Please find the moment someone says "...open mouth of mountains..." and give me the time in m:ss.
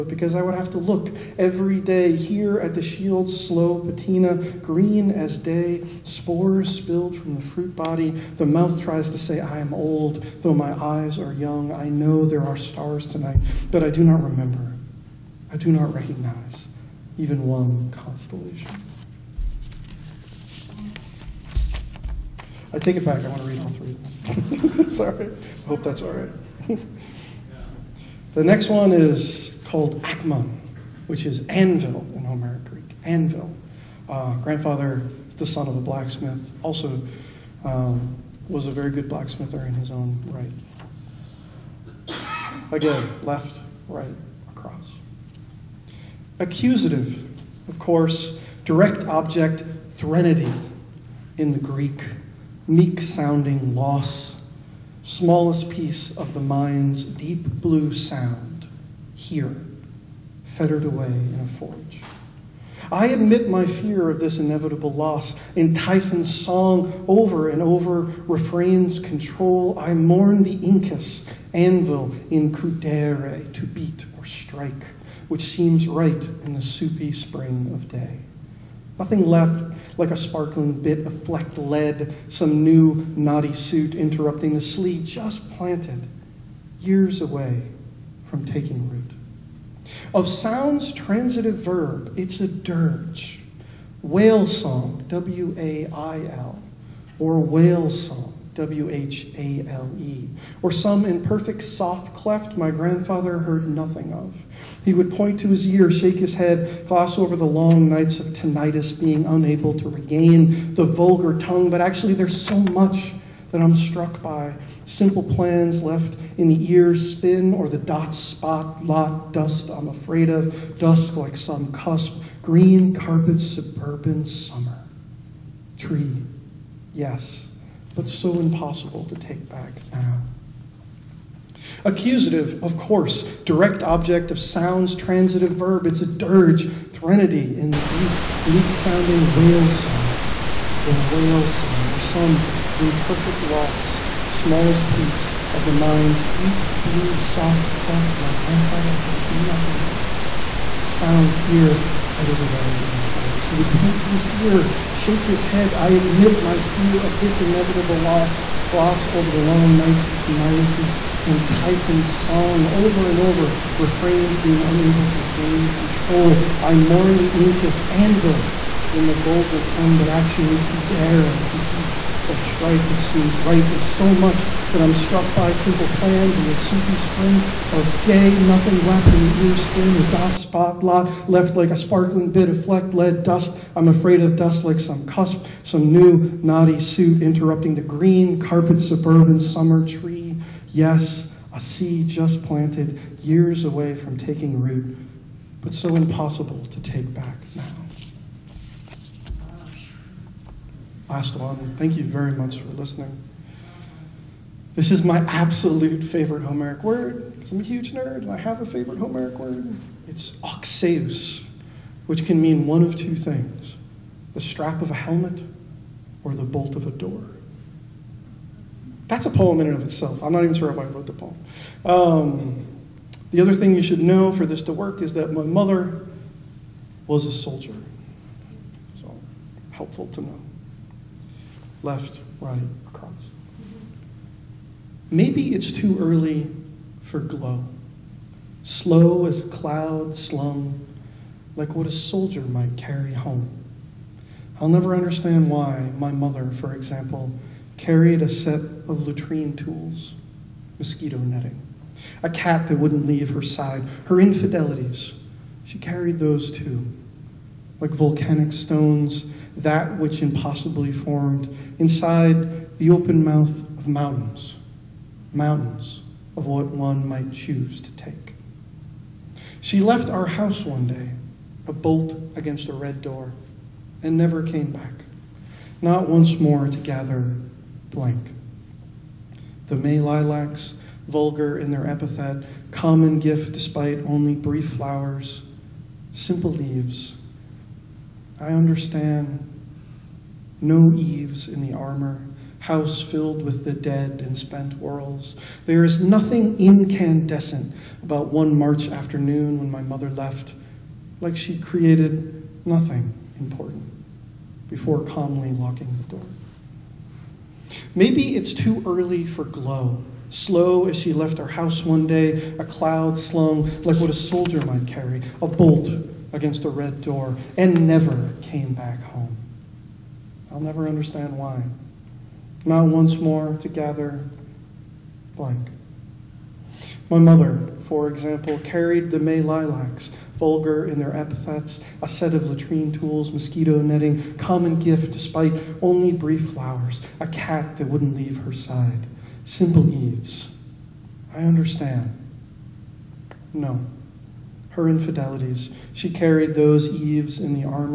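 4:22.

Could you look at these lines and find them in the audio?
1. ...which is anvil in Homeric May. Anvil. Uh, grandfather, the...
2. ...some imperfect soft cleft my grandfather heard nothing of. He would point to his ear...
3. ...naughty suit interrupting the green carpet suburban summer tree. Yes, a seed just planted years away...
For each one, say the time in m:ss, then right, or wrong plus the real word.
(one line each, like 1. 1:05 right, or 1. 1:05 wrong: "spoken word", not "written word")
1. 0:31 wrong: "Greek", not "May"
2. 1:40 right
3. 3:06 right.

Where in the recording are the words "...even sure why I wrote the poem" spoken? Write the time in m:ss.
3:40.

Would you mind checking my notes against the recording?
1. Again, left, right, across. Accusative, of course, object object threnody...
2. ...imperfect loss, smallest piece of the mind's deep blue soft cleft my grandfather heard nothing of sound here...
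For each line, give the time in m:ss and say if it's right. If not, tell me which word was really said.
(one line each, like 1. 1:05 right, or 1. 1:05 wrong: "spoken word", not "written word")
1. 0:42 wrong: "direct", not "object"
2. 2:22 right.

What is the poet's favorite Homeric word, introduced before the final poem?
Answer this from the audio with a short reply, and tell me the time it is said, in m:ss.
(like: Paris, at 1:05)
oxeus, at 3:30.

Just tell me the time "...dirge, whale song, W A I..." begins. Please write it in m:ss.
1:32.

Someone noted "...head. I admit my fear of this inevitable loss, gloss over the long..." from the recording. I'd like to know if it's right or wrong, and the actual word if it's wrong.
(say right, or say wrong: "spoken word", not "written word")
right.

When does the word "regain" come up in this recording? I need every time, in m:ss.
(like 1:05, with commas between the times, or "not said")
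1:49, 2:45.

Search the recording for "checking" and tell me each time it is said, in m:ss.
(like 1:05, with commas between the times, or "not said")
not said.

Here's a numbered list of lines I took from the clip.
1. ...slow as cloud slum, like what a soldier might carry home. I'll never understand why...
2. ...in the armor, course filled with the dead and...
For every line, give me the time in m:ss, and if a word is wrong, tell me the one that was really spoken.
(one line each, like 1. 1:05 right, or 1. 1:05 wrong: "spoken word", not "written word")
1. 3:58 right
2. 4:51 wrong: "house", not "course".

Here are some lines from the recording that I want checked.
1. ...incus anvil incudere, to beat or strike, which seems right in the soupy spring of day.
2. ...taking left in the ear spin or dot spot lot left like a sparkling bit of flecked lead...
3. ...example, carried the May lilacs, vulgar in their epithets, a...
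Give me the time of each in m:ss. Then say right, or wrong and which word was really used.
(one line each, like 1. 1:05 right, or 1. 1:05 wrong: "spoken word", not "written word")
1. 1:10 right
2. 2:58 wrong: "nothing", not "taking"
3. 5:28 right.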